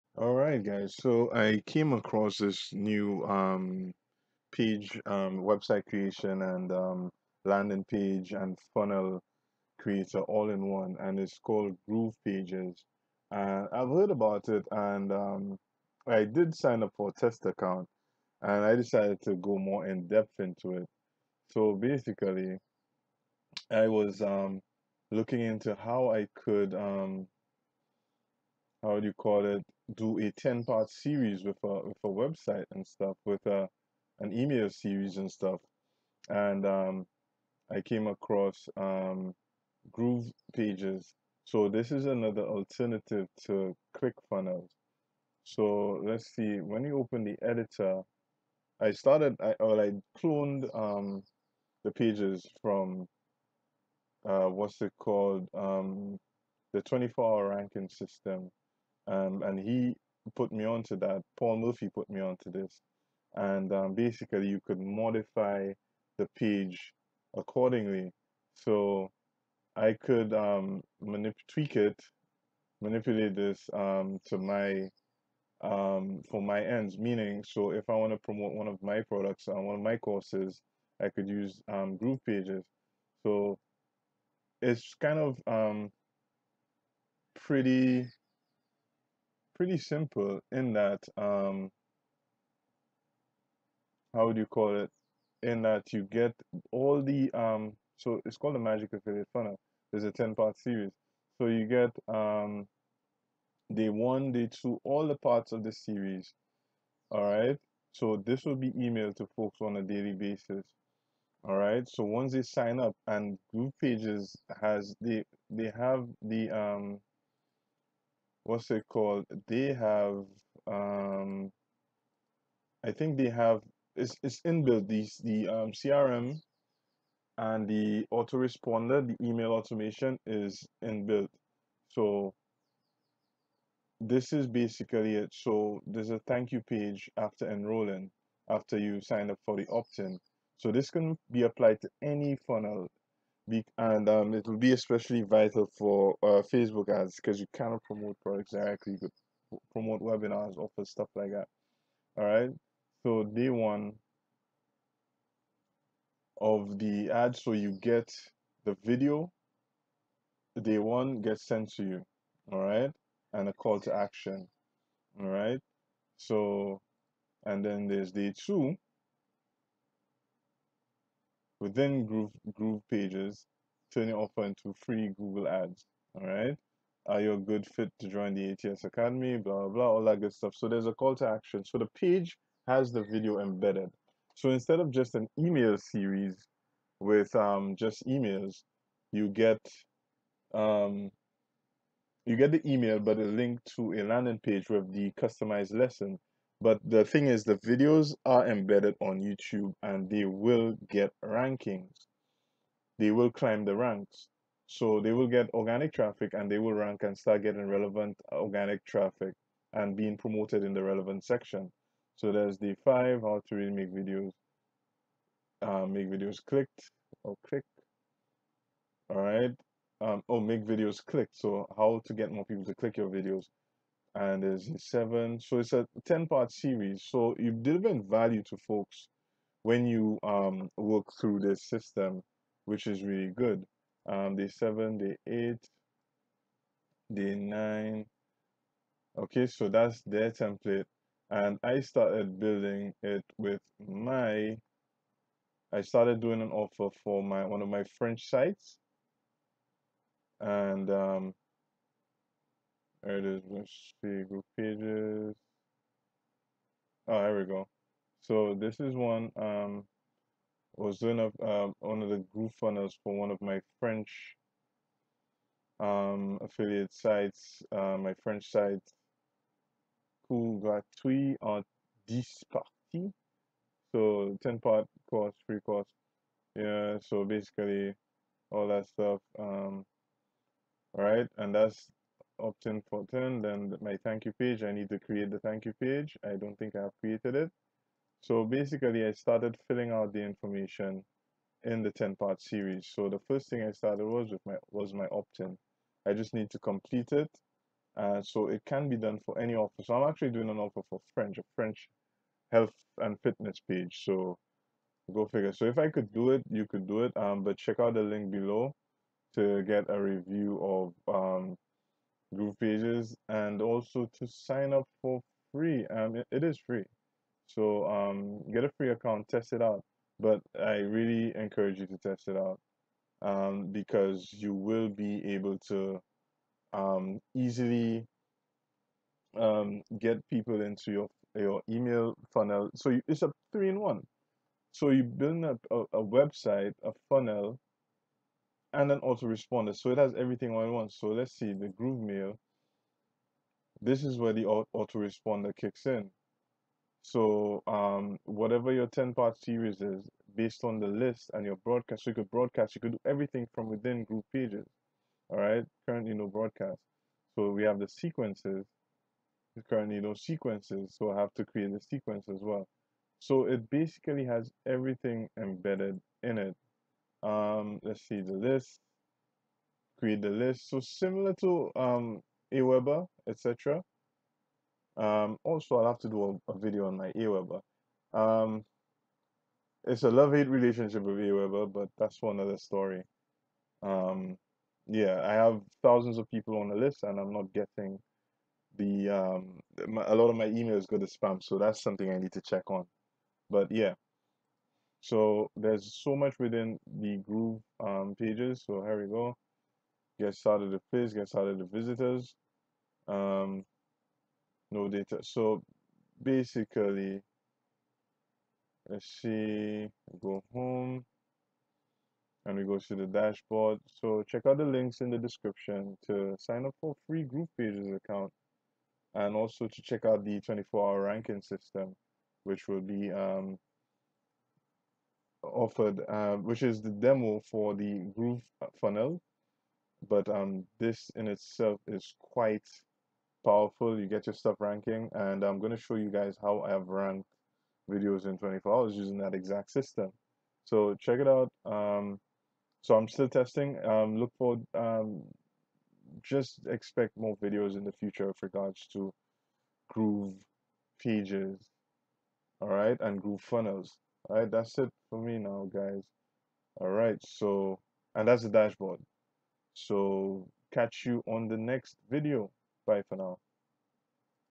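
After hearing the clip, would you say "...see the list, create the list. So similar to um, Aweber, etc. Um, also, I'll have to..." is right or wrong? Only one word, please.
right.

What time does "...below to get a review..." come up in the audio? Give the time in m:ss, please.
5:08.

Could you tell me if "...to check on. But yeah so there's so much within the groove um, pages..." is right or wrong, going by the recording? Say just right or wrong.
right.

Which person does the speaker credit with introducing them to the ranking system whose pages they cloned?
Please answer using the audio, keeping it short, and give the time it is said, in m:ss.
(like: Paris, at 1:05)
Paul Murphy, at 1:01.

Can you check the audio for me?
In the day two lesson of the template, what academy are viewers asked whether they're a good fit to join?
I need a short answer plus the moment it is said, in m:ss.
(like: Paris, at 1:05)
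ATS Academy, at 2:58.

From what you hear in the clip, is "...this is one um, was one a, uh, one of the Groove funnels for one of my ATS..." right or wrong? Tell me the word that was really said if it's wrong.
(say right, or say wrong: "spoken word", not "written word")
wrong: "French", not "ATS".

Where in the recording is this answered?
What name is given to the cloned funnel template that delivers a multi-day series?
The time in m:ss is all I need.
1:38.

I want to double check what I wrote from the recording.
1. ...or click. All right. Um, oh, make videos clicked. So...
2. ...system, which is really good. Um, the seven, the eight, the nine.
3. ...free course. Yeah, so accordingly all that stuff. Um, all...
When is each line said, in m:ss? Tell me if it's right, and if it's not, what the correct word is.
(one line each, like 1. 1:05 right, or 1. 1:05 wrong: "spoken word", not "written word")
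1. 3:37 right
2. 3:51 right
3. 4:35 wrong: "basically", not "accordingly".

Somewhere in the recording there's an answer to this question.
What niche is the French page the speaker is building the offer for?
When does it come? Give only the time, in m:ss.
5:02.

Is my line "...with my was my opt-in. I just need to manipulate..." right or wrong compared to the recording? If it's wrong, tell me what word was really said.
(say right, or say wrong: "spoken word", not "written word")
wrong: "complete", not "manipulate".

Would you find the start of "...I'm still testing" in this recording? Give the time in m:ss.
7:22.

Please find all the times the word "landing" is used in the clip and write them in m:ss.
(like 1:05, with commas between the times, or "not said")
0:07, 3:14.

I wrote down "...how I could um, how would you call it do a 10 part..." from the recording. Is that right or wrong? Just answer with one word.
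right.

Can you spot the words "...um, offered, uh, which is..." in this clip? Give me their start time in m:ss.
7:03.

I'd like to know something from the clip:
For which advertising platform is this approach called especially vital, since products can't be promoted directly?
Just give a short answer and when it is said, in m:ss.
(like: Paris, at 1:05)
Facebook ads, at 2:26.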